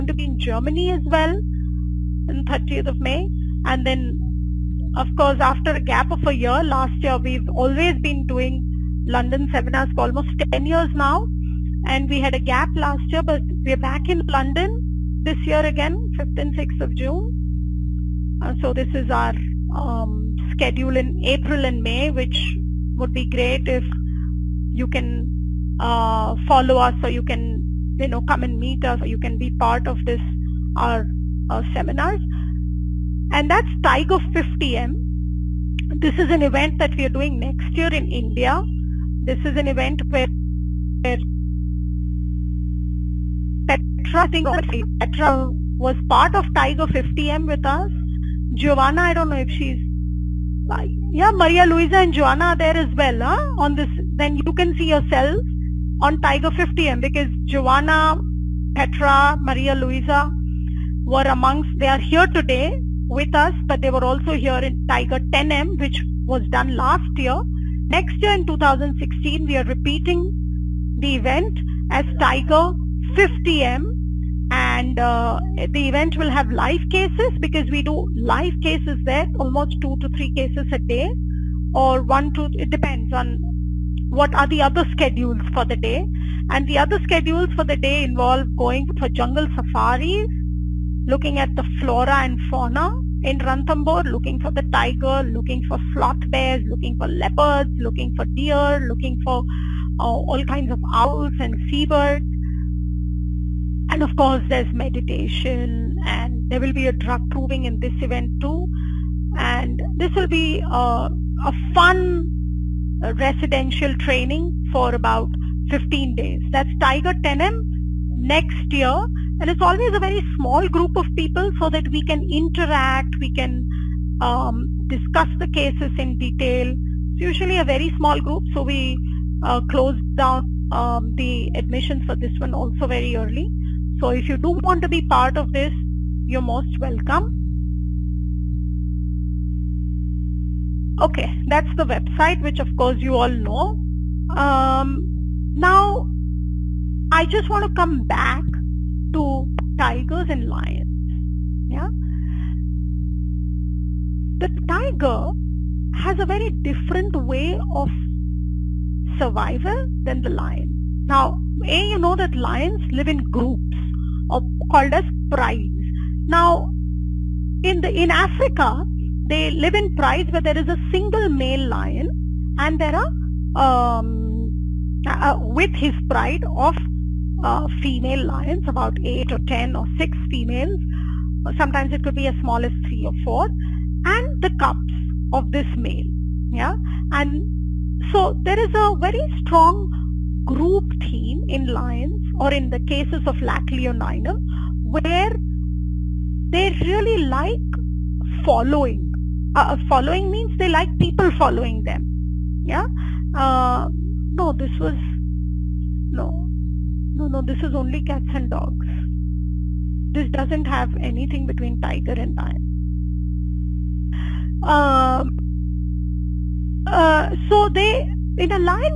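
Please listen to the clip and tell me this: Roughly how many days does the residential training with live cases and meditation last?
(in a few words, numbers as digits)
15 days.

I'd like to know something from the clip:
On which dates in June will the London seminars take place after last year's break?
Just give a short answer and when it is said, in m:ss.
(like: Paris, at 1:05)
5th and 6th of June, at 0:16.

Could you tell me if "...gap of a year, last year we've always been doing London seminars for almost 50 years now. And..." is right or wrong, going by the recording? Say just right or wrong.
wrong.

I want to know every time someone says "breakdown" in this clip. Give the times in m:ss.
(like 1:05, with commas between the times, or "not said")
not said.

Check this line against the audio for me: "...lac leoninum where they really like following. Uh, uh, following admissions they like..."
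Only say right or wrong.
wrong.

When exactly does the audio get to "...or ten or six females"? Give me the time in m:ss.
2:59.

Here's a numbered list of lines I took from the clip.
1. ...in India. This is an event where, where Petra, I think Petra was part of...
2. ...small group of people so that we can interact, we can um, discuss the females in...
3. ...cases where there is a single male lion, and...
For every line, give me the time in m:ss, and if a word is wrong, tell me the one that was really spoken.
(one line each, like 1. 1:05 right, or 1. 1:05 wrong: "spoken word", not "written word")
1. 0:37 right
2. 2:00 wrong: "cases", not "females"
3. 2:49 wrong: "prides", not "cases".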